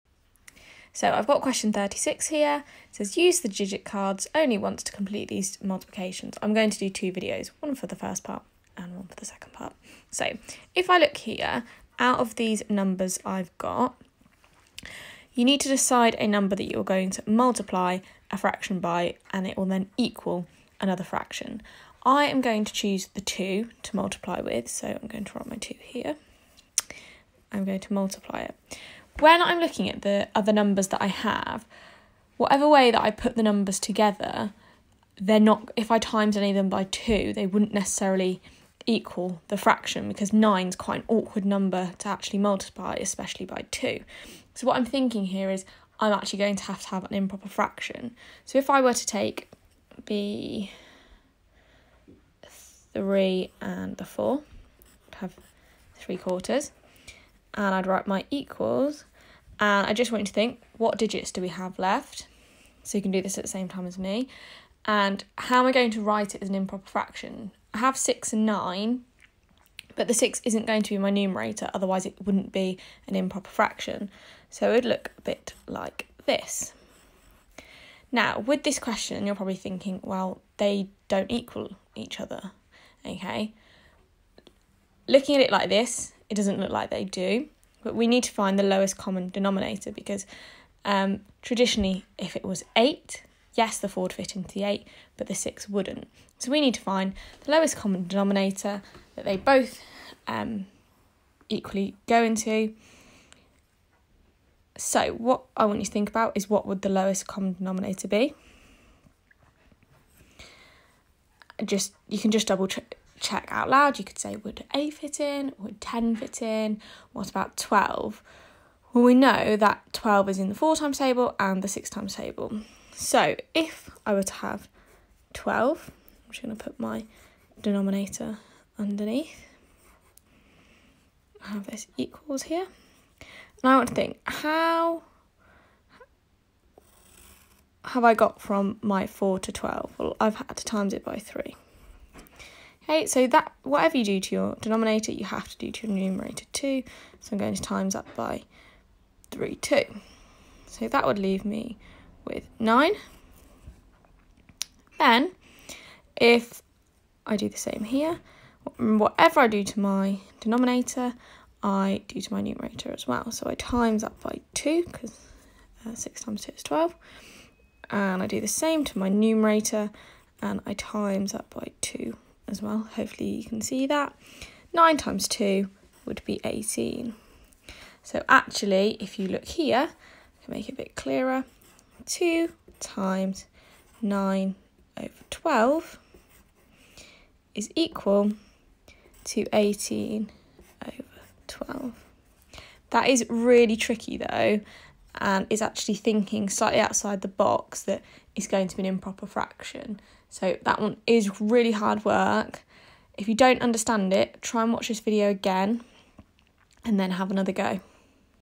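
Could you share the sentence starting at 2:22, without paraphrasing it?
Okay, so that whatever you do to your denominator, you have to do to your numerator too.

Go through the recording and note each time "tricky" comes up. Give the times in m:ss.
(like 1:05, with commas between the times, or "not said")
3:13.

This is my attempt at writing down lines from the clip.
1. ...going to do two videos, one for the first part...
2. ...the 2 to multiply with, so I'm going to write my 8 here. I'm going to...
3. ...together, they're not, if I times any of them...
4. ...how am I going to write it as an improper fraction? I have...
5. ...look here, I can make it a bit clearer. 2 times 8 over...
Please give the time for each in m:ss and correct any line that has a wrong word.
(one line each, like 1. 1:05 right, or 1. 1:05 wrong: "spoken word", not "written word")
1. 0:06 right
2. 0:23 wrong: "2", not "8"
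3. 0:33 right
4. 1:05 right
5. 2:59 wrong: "9", not "8".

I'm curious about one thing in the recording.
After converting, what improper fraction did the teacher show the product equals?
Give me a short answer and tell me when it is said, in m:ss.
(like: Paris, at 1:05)
18/12, at 3:09.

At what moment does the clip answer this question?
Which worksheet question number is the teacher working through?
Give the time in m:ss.
0:01.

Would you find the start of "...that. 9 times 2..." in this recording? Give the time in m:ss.
2:53.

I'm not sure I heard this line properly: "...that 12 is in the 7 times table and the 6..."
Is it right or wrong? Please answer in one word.
wrong.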